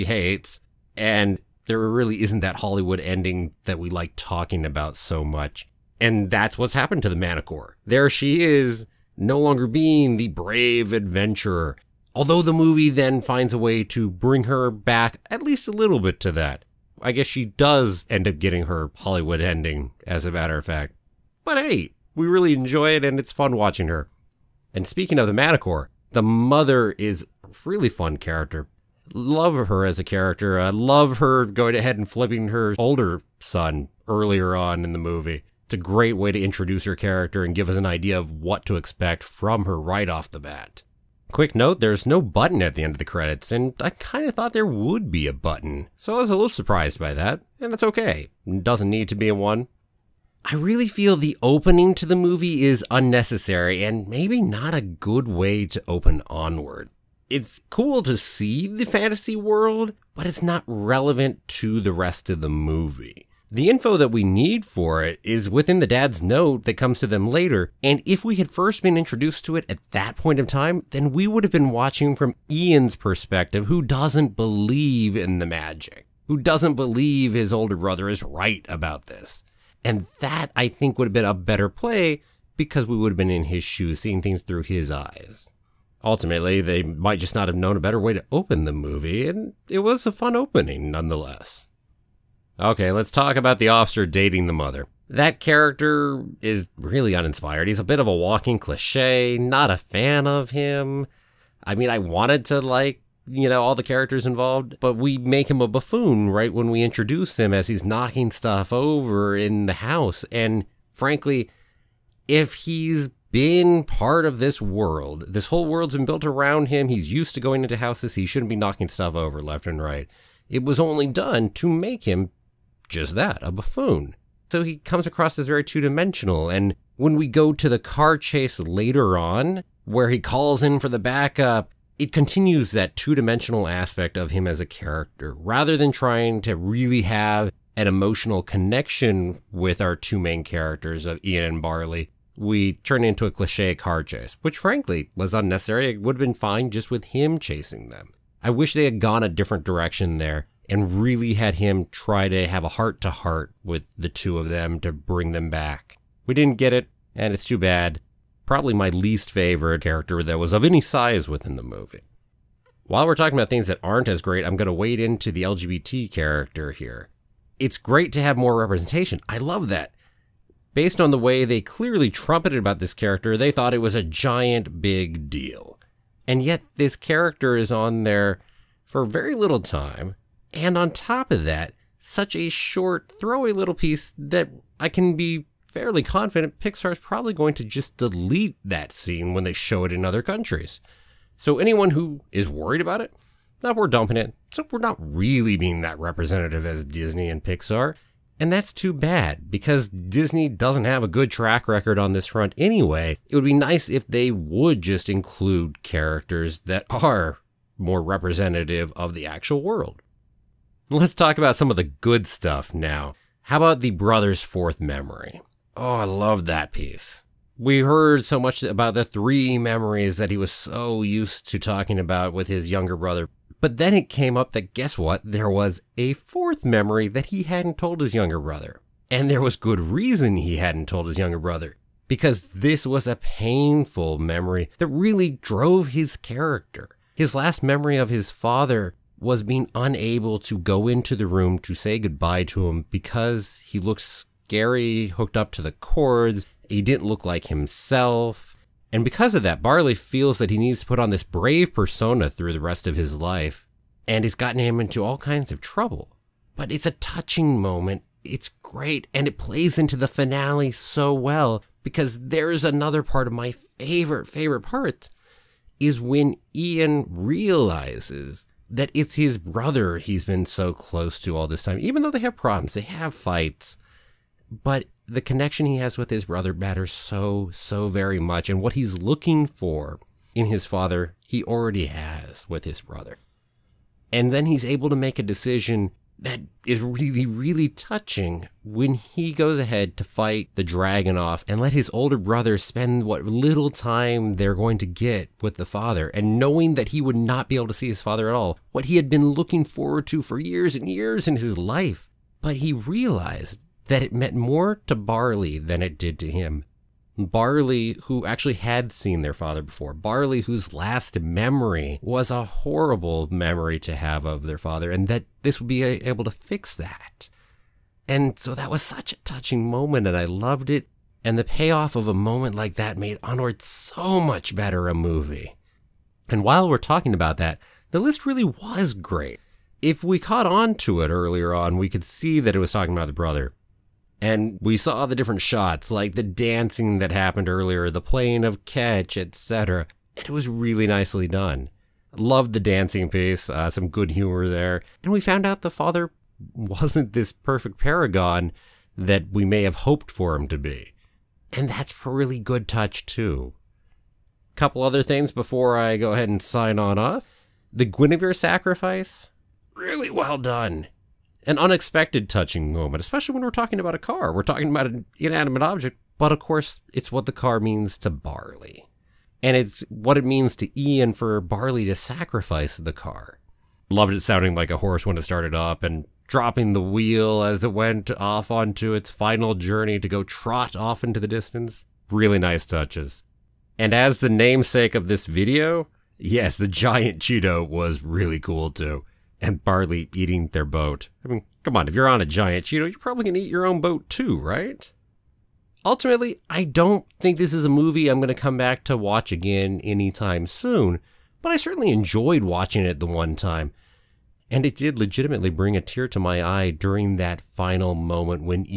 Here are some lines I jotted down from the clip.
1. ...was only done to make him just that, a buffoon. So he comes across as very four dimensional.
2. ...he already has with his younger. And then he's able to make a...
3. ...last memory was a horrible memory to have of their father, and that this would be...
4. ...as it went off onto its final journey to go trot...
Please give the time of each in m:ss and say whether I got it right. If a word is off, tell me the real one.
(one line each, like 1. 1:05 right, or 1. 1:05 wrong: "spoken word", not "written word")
1. 2:00 wrong: "two", not "four"
2. 4:41 wrong: "brother", not "younger"
3. 5:10 right
4. 6:17 right.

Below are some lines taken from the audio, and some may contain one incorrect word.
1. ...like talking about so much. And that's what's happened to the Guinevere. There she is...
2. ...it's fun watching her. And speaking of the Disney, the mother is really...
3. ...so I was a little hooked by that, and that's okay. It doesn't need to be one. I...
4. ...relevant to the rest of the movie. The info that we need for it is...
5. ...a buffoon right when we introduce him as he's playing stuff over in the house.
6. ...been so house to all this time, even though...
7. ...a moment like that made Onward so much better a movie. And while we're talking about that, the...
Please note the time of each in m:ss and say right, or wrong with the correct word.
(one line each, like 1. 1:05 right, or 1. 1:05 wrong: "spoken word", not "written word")
1. 0:03 wrong: "Manticore", not "Guinevere"
2. 0:23 wrong: "Manticore", not "Disney"
3. 0:45 wrong: "surprised", not "hooked"
4. 1:00 right
5. 1:45 wrong: "knocking", not "playing"
6. 4:30 wrong: "close", not "house"
7. 5:22 right.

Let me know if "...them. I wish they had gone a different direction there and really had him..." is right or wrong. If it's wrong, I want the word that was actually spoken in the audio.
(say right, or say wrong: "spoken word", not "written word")
right.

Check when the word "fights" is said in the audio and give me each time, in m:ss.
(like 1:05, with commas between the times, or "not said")
4:33, 4:50.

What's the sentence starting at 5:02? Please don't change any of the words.
But he realized that it meant more to Barley than it did to him.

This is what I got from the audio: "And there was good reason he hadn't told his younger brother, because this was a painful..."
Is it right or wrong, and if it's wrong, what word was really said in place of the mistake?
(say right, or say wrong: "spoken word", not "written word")
right.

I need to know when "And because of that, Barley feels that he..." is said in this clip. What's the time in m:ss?
4:08.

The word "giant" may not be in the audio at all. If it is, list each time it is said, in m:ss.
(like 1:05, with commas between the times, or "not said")
2:54, 6:26, 6:32.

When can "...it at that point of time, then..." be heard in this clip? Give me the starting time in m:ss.
1:09.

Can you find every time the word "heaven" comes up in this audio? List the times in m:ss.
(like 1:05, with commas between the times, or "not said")
not said.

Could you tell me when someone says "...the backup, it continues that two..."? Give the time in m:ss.
2:10.